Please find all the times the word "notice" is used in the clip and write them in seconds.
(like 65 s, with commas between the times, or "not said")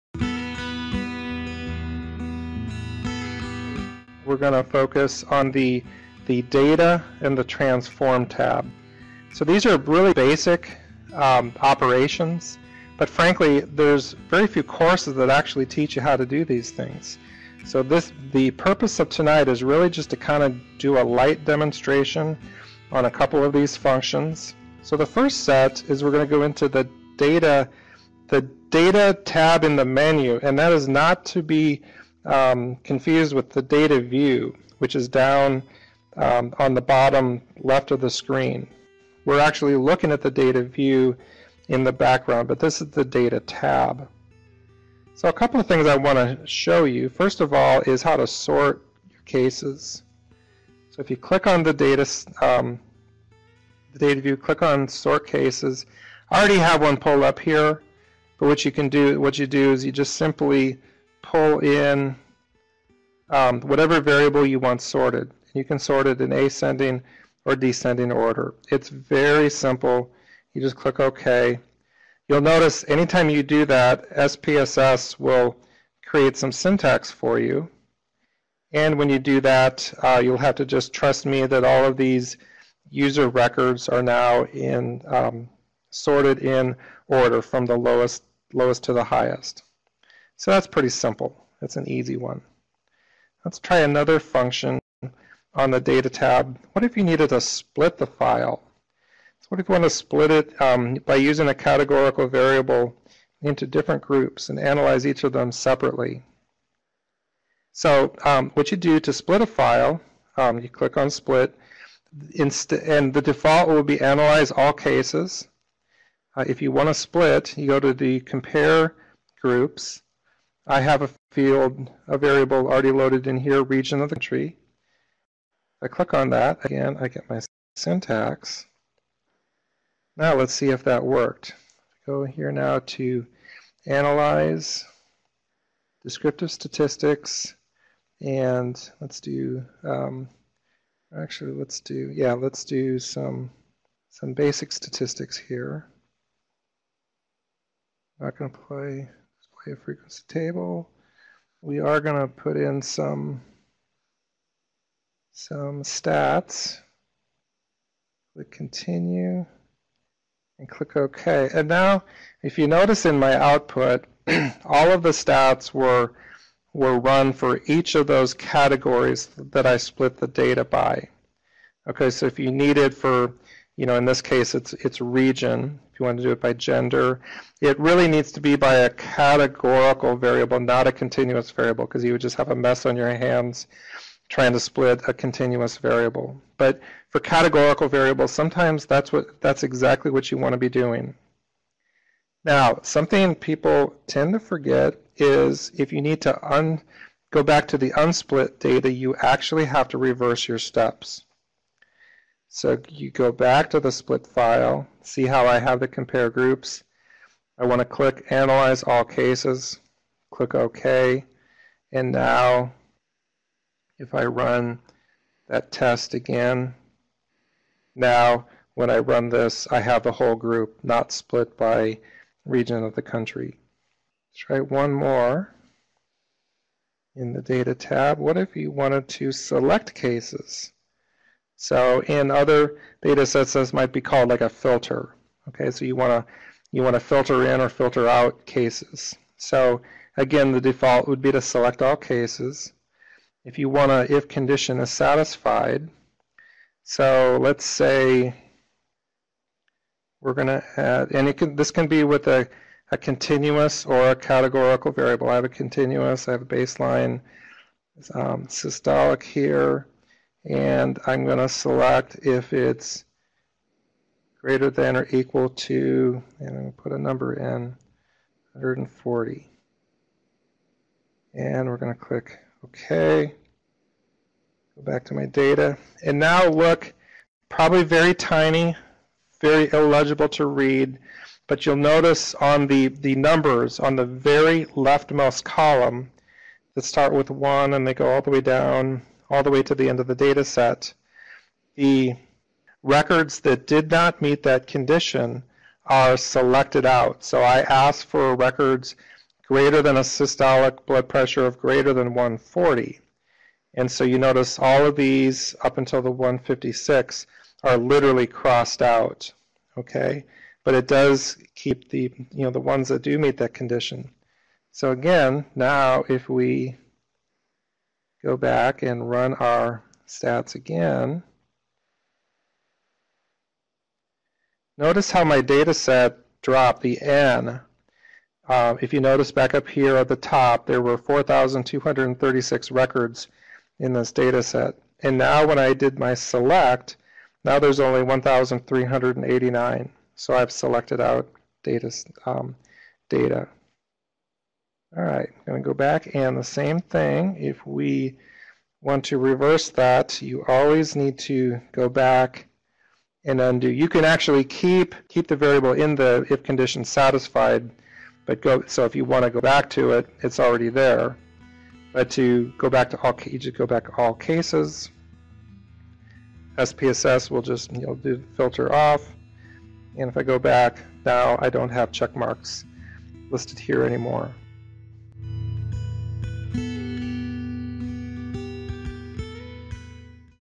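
72 s, 162 s, 281 s, 304 s, 324 s, 328 s.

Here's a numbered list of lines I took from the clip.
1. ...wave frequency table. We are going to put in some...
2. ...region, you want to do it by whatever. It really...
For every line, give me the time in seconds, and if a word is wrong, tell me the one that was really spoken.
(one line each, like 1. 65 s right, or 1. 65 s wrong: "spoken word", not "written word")
1. 149 s right
2. 175 s wrong: "gender", not "whatever".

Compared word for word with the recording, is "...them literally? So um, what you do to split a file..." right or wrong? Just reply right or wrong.
wrong.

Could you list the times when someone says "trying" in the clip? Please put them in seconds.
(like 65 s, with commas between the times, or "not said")
184 s.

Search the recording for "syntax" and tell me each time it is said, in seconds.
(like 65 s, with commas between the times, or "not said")
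76 s, 127 s.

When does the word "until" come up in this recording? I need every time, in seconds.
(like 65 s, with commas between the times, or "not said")
305 s.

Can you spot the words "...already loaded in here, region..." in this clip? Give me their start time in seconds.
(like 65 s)
122 s.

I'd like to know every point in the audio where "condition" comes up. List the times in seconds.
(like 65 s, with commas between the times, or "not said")
244 s, 294 s, 313 s, 356 s.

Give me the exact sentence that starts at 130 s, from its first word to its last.
Now let's see if that worked.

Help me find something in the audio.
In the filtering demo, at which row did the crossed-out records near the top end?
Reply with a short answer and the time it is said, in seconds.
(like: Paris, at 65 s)
156, at 306 s.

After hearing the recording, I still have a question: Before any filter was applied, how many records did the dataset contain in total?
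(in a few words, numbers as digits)
4,236.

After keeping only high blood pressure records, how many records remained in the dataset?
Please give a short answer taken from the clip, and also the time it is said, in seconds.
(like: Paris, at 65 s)
1,389, at 338 s.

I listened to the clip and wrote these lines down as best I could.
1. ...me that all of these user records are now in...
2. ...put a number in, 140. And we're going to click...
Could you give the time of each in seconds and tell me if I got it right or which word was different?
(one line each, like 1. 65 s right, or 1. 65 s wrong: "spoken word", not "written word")
1. 81 s right
2. 266 s right.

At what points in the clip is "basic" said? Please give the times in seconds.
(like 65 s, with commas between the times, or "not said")
10 s, 144 s.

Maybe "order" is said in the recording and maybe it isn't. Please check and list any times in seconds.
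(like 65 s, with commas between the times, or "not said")
68 s, 87 s.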